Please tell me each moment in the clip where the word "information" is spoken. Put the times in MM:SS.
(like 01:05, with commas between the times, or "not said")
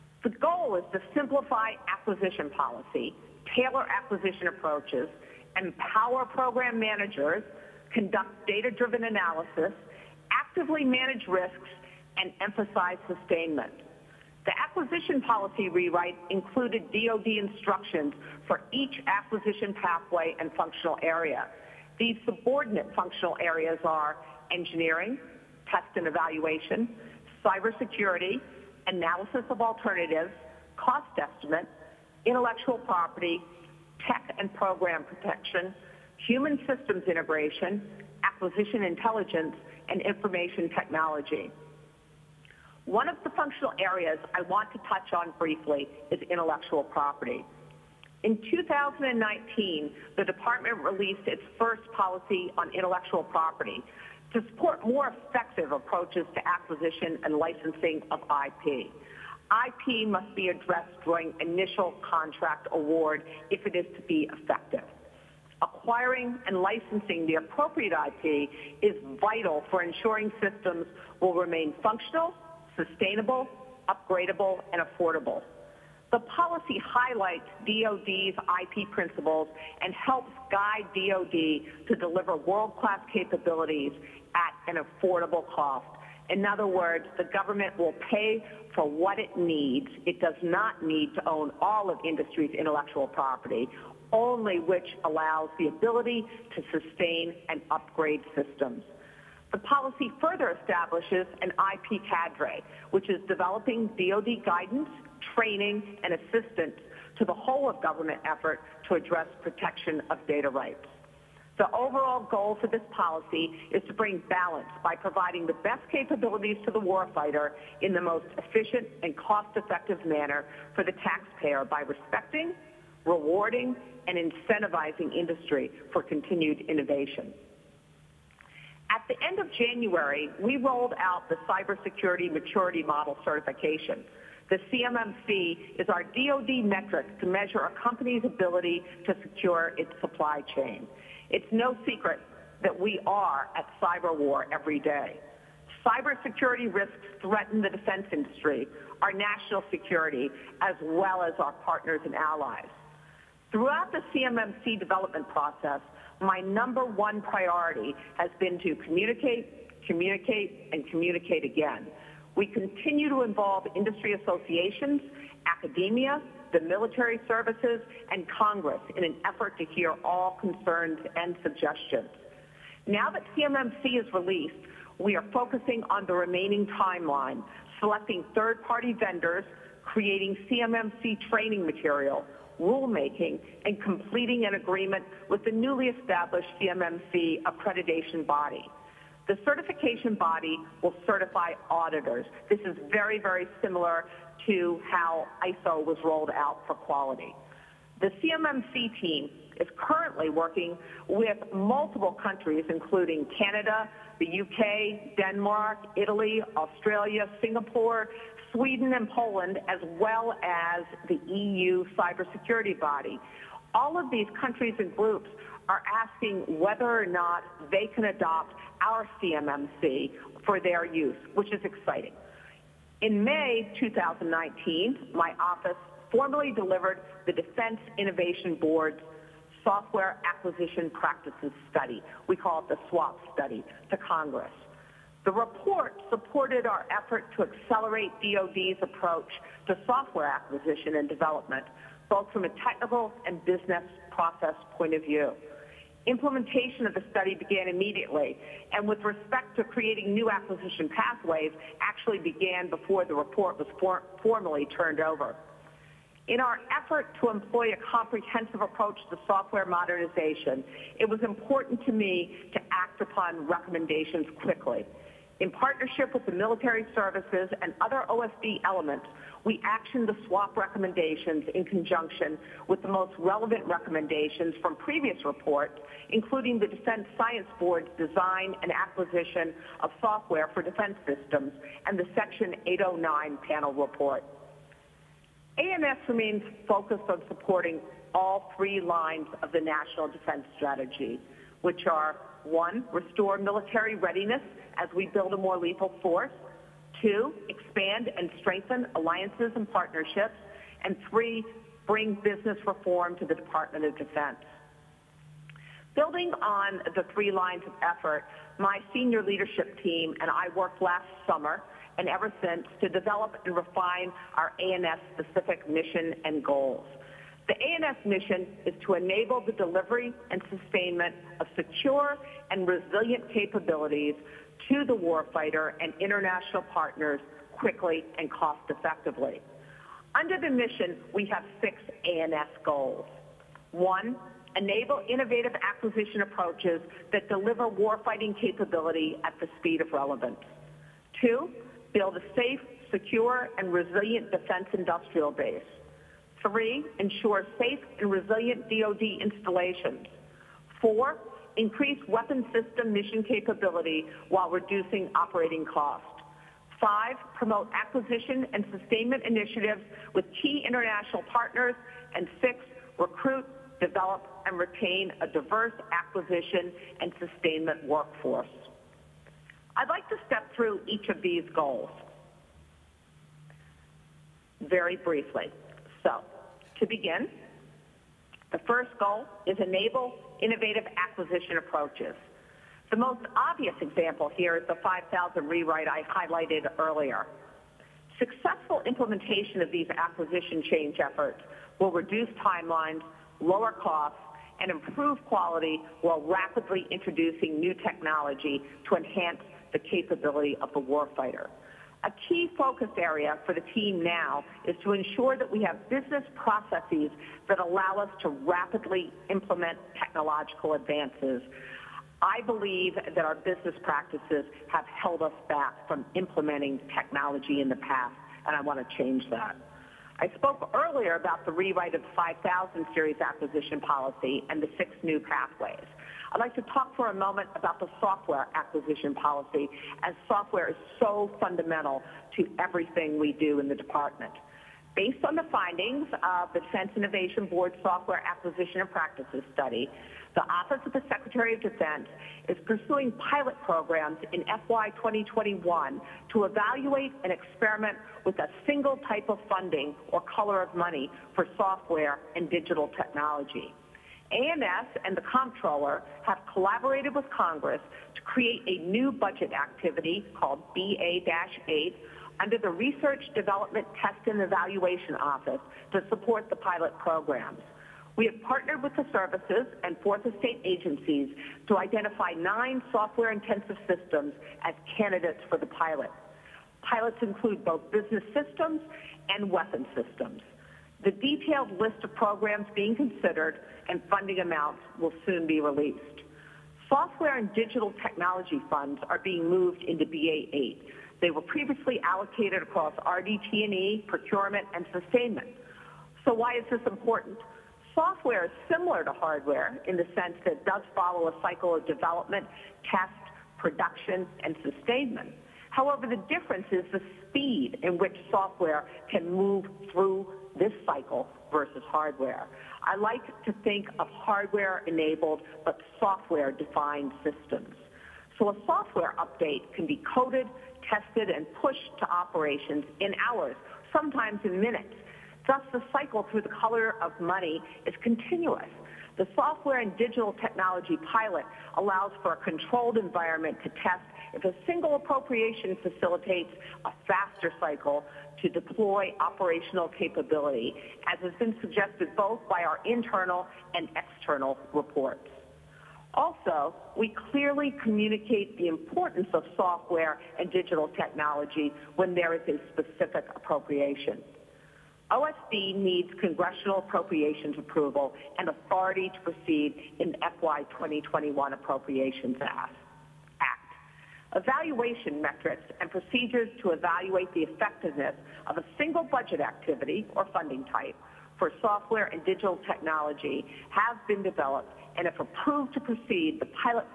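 00:40.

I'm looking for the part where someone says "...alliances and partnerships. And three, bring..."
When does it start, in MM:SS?
04:58.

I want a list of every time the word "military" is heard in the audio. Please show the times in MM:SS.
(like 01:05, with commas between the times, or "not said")
02:46, 04:26, 04:53.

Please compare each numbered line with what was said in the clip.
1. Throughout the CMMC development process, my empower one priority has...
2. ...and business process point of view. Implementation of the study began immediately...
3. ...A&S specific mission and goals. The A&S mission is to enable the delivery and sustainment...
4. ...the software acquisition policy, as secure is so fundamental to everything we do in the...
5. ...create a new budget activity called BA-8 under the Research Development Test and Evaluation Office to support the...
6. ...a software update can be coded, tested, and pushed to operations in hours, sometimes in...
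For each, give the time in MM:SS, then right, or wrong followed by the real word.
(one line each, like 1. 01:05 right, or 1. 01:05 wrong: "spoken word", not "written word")
1. 02:33 wrong: "number", not "empower"
2. 04:03 right
3. 05:14 right
4. 07:07 wrong: "software", not "secure"
5. 07:38 right
6. 08:38 right.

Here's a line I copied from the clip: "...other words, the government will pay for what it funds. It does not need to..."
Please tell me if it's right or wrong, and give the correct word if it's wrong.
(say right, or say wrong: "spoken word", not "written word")
wrong: "needs", not "funds".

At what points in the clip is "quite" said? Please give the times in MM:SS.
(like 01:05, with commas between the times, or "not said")
not said.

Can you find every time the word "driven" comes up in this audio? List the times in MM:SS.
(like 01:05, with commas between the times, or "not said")
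00:08.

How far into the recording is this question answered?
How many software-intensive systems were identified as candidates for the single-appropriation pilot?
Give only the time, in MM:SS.
07:52.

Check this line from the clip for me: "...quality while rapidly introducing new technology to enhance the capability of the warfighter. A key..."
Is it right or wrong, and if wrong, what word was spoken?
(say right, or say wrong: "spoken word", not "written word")
right.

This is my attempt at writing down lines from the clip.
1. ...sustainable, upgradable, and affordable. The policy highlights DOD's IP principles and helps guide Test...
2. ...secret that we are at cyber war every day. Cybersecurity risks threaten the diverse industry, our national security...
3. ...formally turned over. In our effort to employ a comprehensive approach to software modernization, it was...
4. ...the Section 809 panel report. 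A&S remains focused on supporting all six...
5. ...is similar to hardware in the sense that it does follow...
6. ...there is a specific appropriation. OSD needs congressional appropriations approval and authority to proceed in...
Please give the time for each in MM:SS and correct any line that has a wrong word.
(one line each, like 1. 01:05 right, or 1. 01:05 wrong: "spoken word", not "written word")
1. 01:12 wrong: "DOD", not "Test"
2. 02:21 wrong: "defense", not "diverse"
3. 04:14 right
4. 04:41 wrong: "three", not "six"
5. 08:18 right
6. 09:12 right.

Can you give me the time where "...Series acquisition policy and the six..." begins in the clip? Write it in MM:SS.
07:02.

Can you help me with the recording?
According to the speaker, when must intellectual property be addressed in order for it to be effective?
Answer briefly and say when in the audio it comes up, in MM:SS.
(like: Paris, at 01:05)
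initial contract award, at 01:01.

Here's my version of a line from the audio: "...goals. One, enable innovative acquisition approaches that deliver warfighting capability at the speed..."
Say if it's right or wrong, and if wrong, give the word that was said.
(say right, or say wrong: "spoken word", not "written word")
right.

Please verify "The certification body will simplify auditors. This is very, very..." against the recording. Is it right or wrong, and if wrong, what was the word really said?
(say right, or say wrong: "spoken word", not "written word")
wrong: "certify", not "simplify".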